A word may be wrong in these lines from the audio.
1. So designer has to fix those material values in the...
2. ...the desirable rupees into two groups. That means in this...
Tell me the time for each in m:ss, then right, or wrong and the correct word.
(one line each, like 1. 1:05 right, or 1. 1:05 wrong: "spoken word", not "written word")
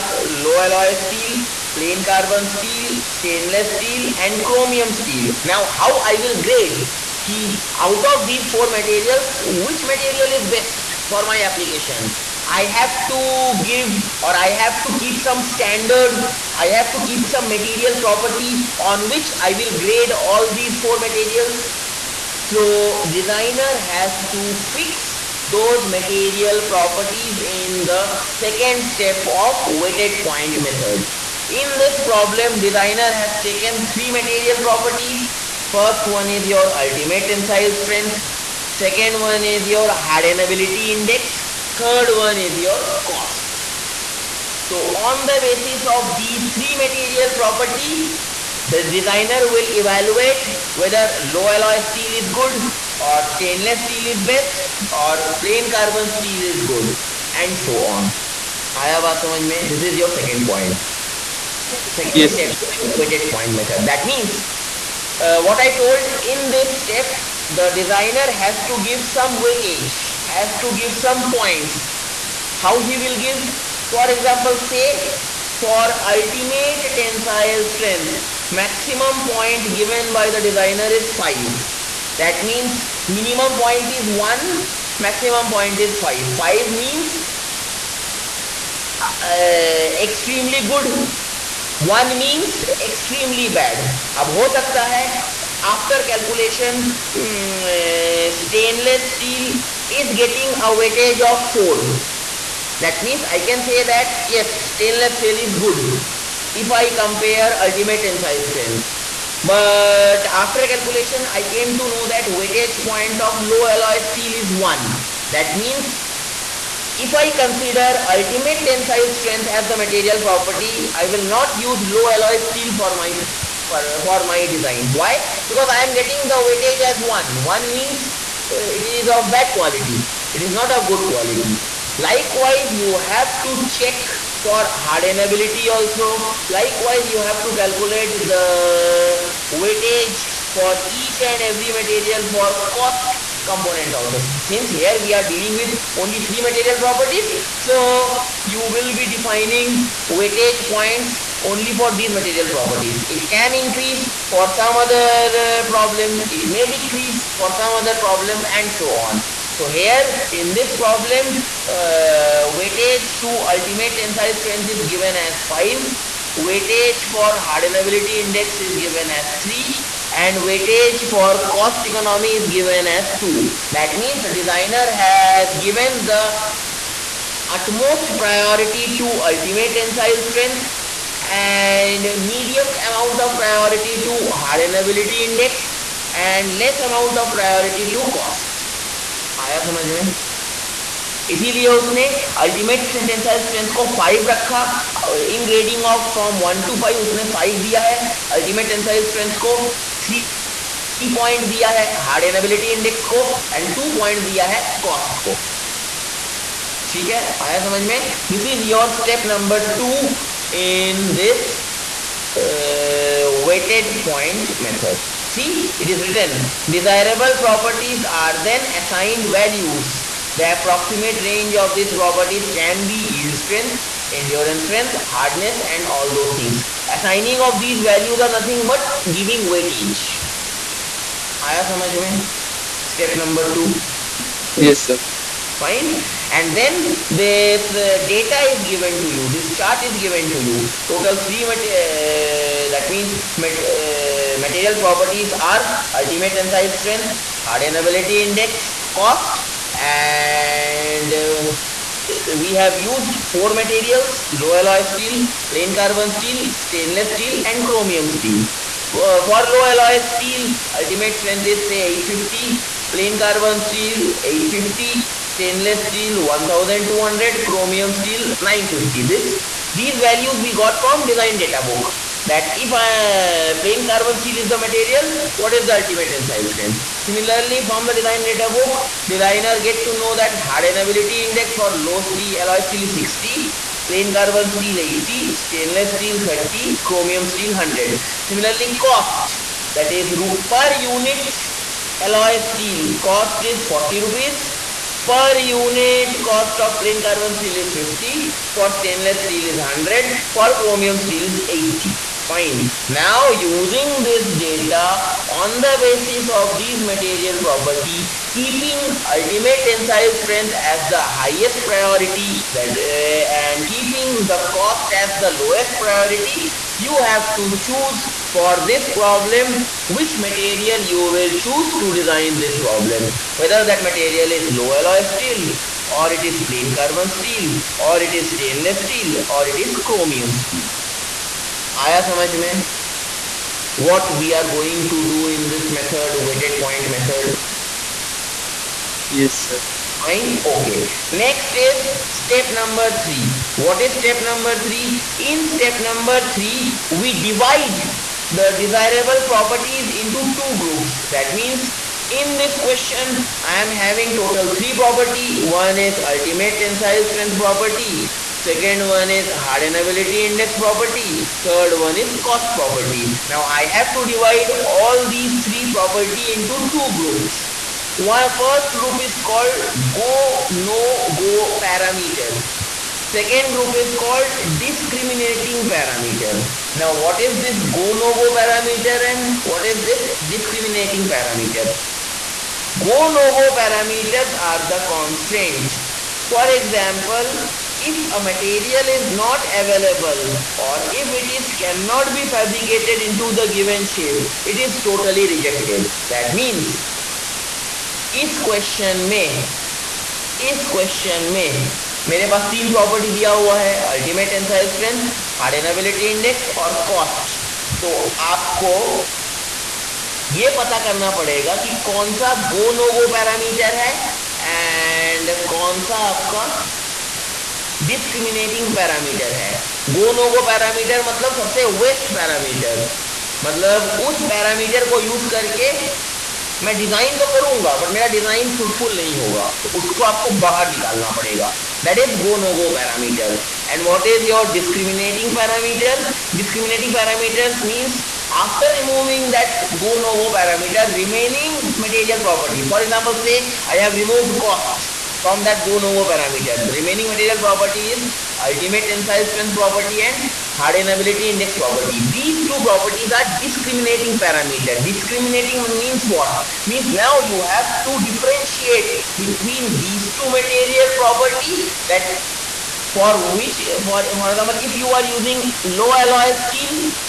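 1. 0:22 wrong: "properties", not "values"
2. 5:48 wrong: "properties", not "rupees".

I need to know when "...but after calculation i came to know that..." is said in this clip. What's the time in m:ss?
1:49.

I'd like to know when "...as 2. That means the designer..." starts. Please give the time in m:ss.
2:52.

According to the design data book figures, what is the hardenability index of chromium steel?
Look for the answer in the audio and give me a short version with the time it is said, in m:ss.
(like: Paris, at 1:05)
100, at 4:46.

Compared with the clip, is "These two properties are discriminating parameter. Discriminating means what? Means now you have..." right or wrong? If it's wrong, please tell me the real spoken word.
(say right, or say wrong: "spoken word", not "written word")
right.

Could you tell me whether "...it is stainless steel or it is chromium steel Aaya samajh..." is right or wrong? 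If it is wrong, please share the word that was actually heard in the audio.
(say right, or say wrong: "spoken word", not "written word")
right.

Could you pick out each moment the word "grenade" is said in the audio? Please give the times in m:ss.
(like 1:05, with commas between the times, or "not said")
not said.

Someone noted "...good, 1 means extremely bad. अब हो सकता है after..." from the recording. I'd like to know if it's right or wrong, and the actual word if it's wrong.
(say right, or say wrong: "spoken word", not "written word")
right.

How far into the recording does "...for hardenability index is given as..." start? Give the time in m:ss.
2:47.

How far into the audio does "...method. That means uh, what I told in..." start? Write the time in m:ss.
1:03.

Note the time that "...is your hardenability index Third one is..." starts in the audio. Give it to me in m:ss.
0:39.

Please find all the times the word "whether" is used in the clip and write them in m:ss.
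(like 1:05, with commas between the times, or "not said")
0:50, 5:23.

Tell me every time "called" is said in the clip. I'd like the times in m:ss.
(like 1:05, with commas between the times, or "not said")
6:09, 6:13.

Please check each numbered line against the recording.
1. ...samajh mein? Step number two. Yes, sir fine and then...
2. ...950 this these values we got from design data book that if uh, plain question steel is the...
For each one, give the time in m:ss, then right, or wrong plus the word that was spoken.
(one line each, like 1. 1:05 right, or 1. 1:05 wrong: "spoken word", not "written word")
1. 3:51 right
2. 4:28 wrong: "carbon", not "question".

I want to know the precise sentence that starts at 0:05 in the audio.
Now, how I will grade key out of these four materials, which material is best for my application?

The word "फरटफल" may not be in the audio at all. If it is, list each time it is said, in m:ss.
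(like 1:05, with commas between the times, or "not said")
7:08.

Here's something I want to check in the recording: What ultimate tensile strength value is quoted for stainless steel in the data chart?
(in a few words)
1200.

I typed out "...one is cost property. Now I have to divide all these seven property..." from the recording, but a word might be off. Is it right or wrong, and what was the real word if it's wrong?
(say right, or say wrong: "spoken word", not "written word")
wrong: "three", not "seven".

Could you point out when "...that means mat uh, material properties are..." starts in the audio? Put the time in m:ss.
4:02.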